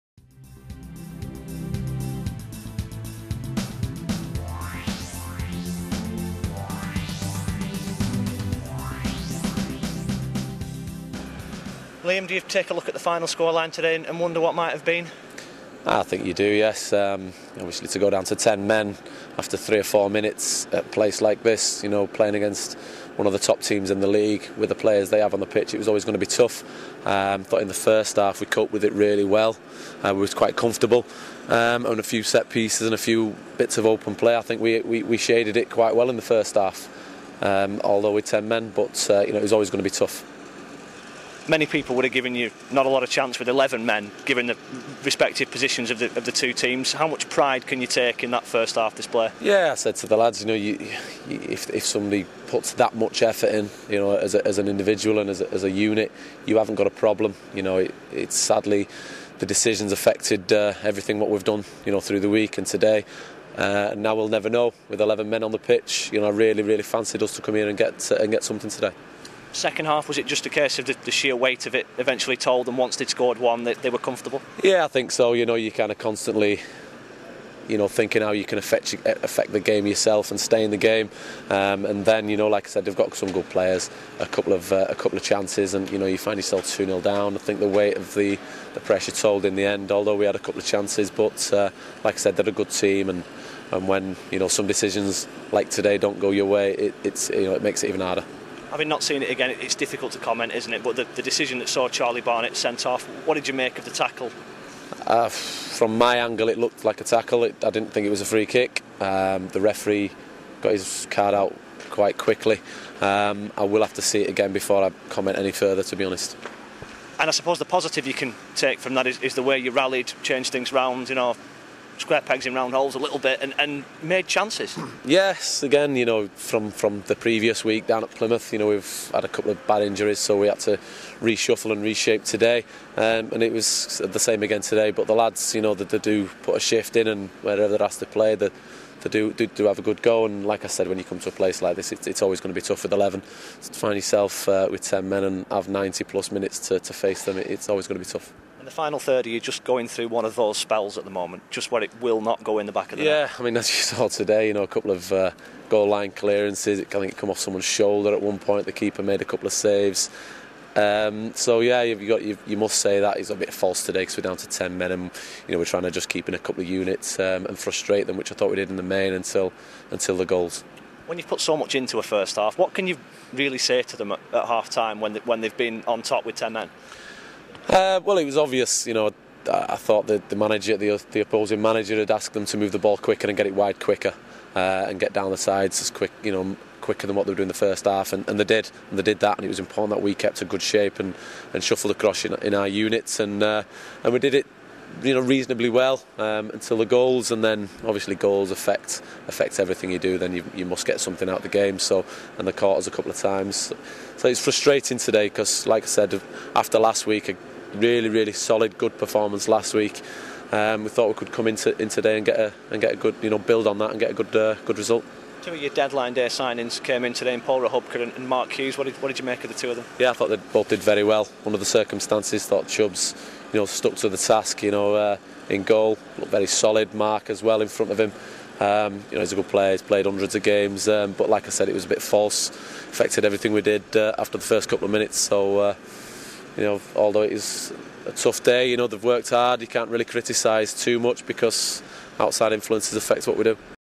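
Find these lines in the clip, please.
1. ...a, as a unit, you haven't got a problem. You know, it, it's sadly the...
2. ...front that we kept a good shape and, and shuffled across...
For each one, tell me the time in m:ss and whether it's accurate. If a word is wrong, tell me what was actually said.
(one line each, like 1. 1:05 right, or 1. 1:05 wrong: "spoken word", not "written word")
1. 0:55 right
2. 3:09 wrong: "important", not "front".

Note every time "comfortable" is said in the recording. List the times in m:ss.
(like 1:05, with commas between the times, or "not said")
0:30, 1:13.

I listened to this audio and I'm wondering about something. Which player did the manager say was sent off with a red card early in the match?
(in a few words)
Charlie Barnett.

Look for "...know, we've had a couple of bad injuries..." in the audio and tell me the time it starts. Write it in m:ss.
2:08.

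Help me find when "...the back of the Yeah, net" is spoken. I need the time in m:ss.
2:32.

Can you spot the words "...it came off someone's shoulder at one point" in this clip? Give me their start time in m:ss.
2:37.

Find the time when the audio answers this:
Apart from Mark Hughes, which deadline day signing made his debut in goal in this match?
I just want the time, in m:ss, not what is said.
3:37.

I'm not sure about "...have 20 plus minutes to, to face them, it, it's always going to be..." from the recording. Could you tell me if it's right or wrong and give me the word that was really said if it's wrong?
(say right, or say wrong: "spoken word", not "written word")
wrong: "90", not "20".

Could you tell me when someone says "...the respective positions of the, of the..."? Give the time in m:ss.
0:44.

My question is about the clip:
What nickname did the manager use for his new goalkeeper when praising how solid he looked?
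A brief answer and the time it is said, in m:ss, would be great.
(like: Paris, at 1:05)
Chubbs, at 3:42.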